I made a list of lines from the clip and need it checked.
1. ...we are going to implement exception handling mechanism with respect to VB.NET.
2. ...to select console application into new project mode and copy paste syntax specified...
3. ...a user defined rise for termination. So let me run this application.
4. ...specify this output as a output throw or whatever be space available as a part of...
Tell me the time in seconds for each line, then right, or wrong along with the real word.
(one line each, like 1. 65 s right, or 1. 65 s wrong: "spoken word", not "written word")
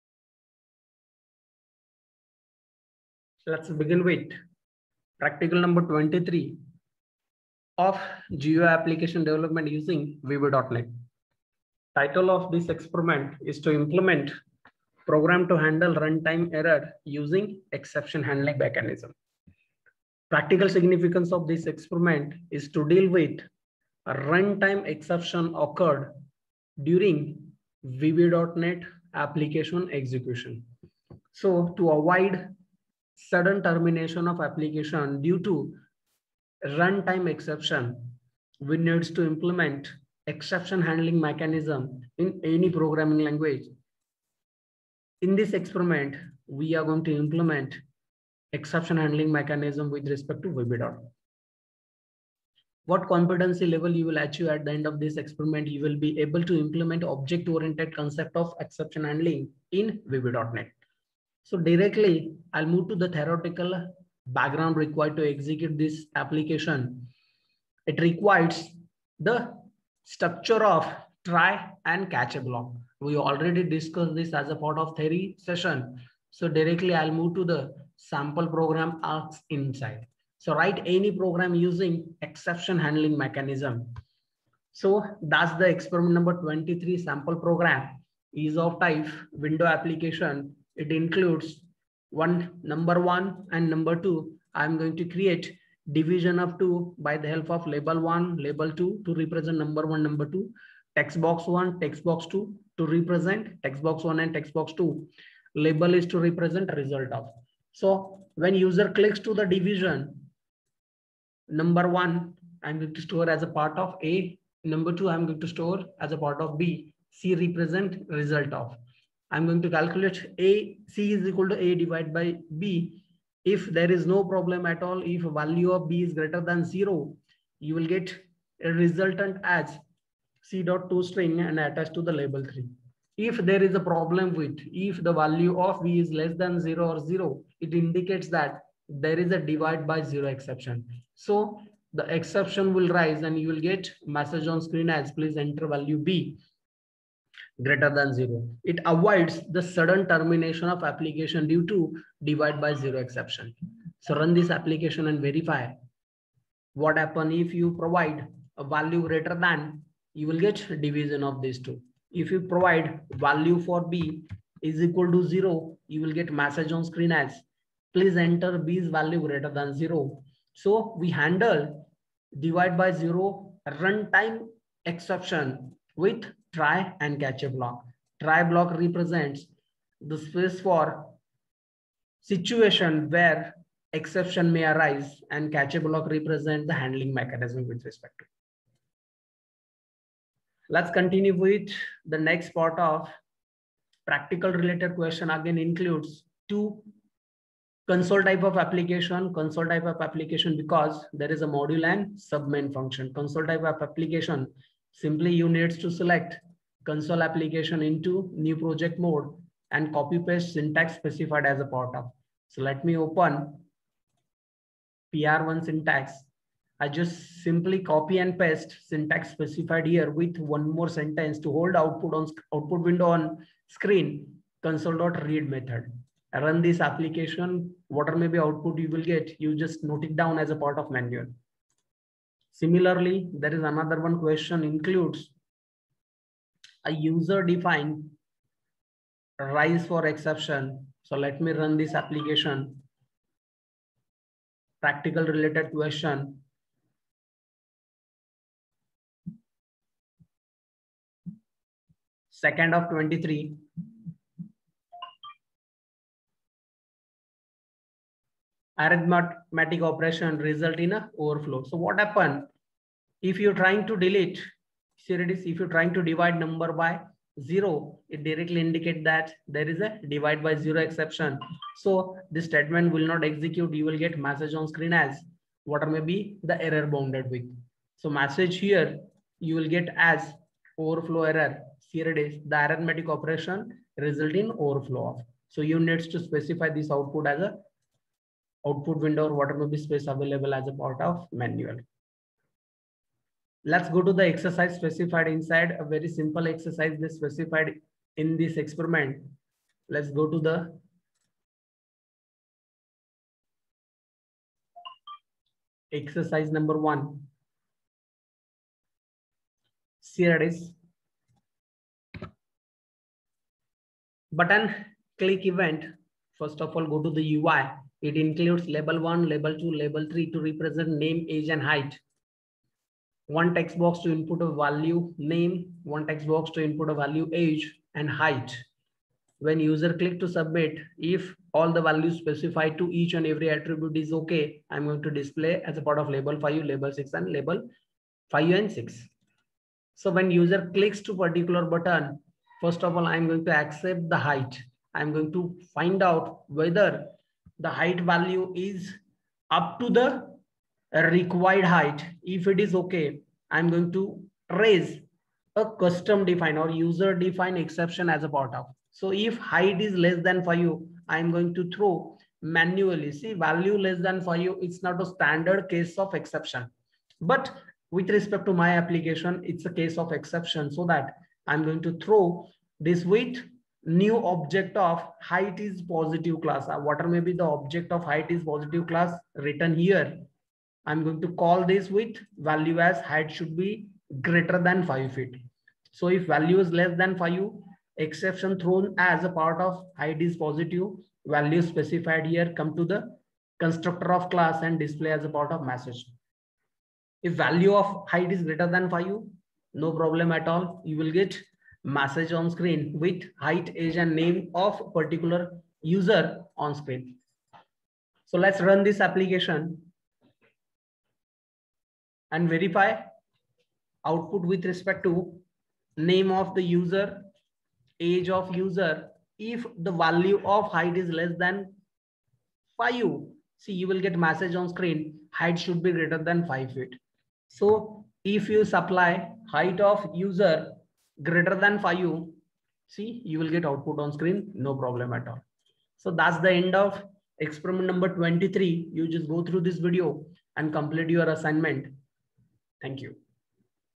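1. 46 s right
2. 205 s right
3. 236 s wrong: "exception", not "termination"
4. 286 s wrong: "window", not "throw".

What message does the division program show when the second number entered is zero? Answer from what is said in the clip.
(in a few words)
Please enter value B greater than zero.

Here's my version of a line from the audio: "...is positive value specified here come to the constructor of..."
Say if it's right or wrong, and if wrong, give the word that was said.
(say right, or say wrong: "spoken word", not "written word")
right.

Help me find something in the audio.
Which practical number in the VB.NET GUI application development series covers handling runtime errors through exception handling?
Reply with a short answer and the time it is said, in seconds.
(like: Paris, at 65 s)
23, at 5 s.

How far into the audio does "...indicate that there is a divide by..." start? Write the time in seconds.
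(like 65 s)
268 s.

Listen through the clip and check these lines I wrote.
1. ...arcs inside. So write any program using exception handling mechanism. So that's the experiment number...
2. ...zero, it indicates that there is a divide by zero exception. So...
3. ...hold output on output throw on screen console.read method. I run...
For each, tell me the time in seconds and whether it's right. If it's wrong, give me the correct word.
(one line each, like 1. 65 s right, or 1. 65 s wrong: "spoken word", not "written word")
1. 79 s right
2. 136 s right
3. 221 s wrong: "window", not "throw".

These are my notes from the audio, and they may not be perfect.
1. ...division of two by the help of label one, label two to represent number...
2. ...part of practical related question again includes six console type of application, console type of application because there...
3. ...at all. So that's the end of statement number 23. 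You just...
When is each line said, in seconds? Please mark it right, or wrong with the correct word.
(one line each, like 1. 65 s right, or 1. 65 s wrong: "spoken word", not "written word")
1. 95 s right
2. 192 s wrong: "two", not "six"
3. 435 s wrong: "experiment", not "statement".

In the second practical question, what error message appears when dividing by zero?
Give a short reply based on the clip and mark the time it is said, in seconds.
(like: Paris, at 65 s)
Overflow error, at 280 s.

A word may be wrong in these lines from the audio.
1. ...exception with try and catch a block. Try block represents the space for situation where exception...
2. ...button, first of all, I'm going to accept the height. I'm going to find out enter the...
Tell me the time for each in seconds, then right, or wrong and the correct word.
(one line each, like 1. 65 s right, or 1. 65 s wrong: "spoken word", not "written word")
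1. 174 s right
2. 341 s wrong: "whether", not "enter".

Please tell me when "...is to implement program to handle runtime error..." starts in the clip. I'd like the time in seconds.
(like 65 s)
13 s.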